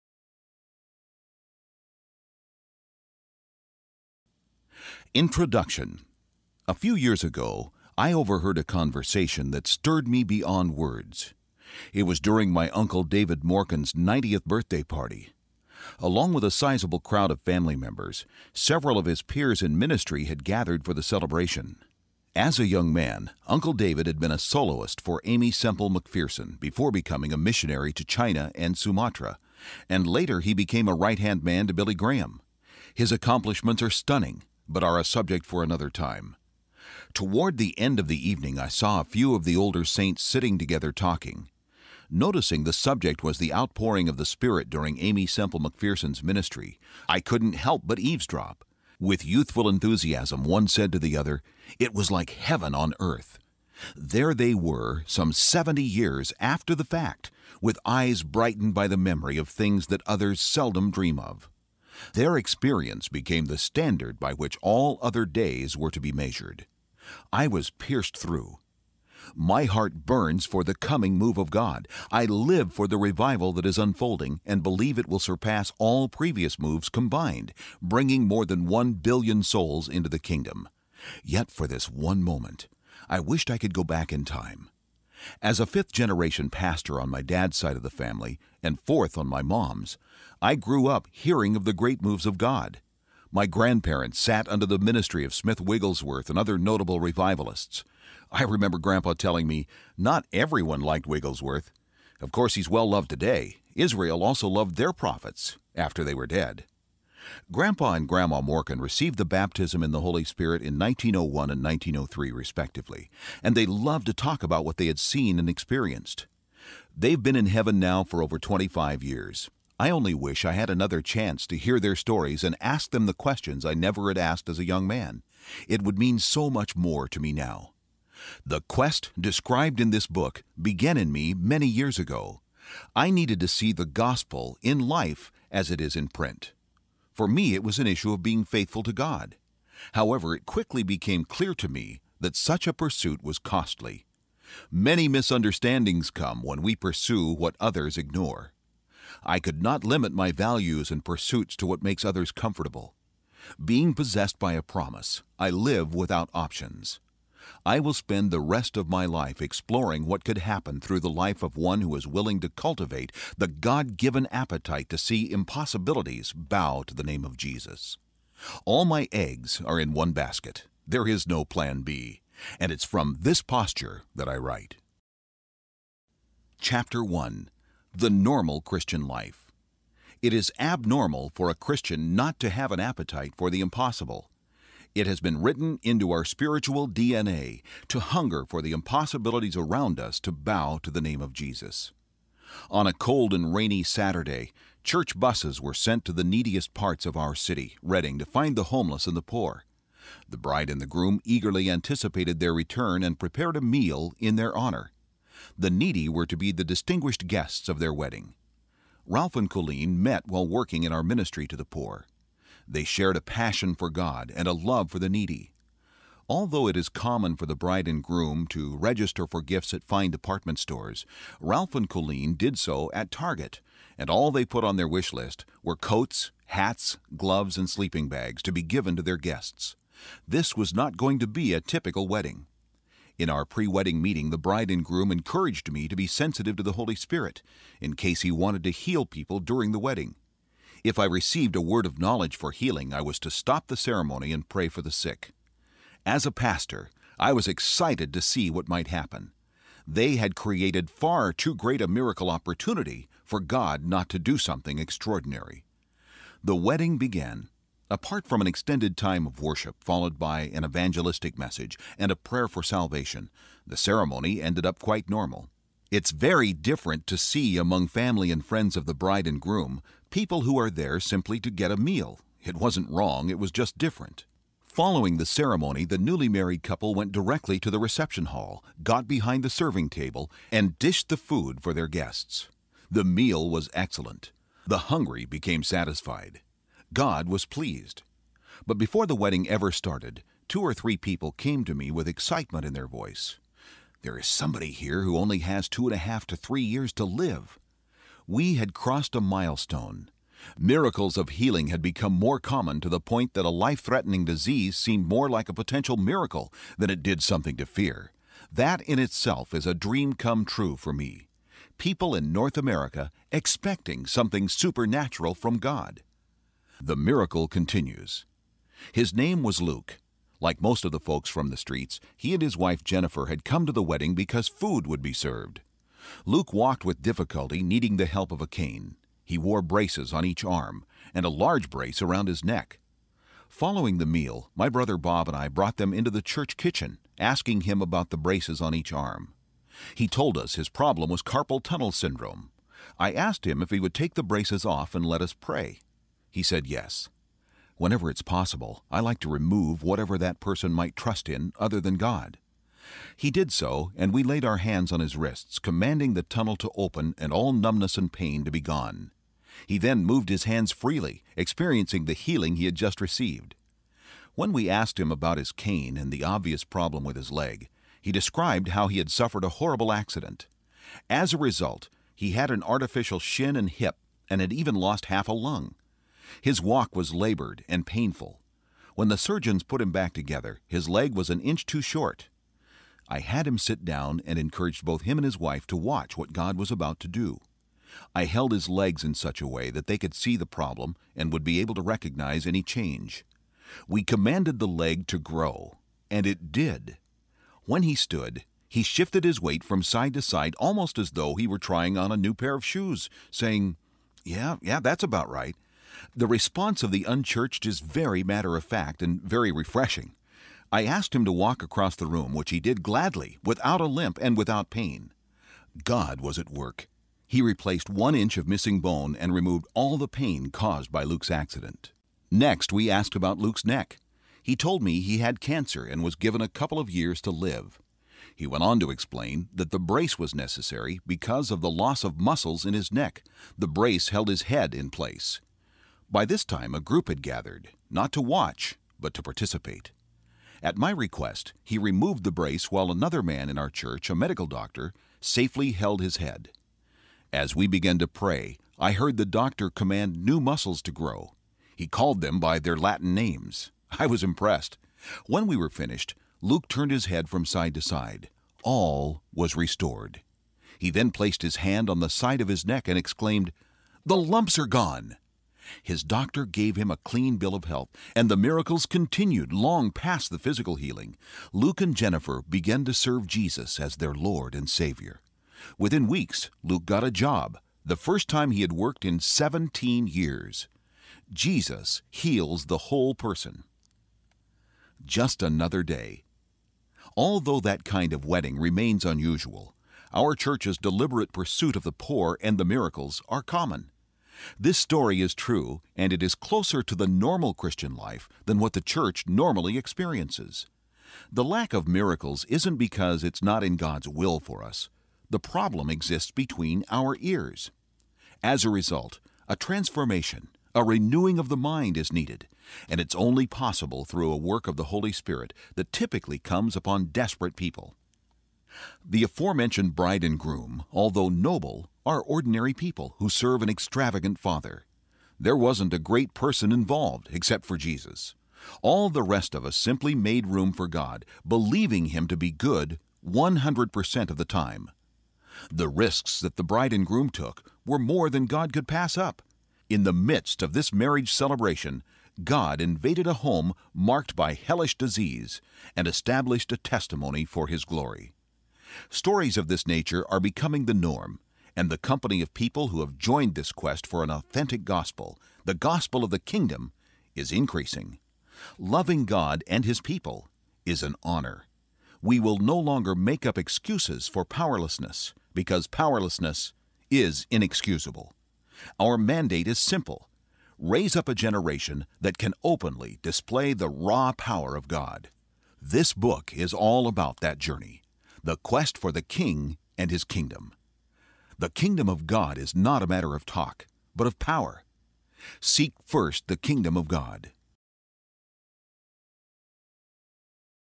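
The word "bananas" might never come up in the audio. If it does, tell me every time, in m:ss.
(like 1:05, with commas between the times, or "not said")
not said.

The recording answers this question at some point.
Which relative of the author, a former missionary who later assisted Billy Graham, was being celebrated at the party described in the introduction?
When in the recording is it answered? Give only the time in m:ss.
0:12.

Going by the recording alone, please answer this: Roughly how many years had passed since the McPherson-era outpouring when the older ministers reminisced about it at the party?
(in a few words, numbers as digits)
70 years.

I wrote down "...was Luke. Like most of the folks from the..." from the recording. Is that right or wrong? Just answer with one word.
right.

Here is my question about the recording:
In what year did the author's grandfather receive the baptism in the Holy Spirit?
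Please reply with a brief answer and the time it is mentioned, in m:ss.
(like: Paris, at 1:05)
1901, at 1:50.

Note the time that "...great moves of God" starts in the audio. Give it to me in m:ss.
1:31.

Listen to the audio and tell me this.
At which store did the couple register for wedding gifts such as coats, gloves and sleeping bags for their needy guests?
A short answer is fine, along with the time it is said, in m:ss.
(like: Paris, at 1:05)
Target, at 3:43.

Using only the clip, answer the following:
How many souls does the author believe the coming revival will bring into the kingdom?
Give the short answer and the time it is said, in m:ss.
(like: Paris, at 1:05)
More than 1 billion, at 1:18.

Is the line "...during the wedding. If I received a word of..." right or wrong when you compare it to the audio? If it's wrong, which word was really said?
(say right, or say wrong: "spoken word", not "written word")
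right.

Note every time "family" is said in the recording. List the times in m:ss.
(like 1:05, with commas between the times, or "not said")
0:17, 1:27, 4:27.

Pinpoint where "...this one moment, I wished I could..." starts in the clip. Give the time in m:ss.
1:21.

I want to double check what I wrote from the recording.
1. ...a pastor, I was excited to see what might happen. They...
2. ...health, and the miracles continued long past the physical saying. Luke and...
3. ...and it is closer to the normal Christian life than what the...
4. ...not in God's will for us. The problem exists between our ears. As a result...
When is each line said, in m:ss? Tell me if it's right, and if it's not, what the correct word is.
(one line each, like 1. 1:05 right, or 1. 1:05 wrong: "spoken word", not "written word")
1. 4:06 right
2. 7:47 wrong: "healing", not "saying"
3. 8:15 right
4. 8:23 right.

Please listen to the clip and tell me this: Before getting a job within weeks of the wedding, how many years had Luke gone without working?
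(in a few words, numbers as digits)
17 years.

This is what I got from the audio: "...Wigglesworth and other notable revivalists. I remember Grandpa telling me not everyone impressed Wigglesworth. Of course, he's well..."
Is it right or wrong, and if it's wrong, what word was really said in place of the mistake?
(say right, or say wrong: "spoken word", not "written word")
wrong: "liked", not "impressed".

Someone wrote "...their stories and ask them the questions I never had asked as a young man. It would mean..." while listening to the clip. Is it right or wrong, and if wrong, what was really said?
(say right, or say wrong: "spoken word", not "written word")
right.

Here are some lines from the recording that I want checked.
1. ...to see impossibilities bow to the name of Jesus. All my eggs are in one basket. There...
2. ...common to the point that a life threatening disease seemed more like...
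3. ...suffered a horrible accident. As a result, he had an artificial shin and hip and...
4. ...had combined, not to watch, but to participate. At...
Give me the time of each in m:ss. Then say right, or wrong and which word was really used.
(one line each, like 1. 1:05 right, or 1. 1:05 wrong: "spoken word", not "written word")
1. 2:44 right
2. 5:02 right
3. 6:09 right
4. 7:17 wrong: "gathered", not "combined".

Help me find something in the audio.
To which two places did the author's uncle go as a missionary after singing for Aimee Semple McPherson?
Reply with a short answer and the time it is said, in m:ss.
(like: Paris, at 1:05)
China and Sumatra, at 0:28.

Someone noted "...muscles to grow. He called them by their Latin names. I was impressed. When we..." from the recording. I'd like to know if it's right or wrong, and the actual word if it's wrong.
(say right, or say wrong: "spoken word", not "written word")
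right.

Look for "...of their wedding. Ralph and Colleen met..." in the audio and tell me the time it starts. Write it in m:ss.
3:27.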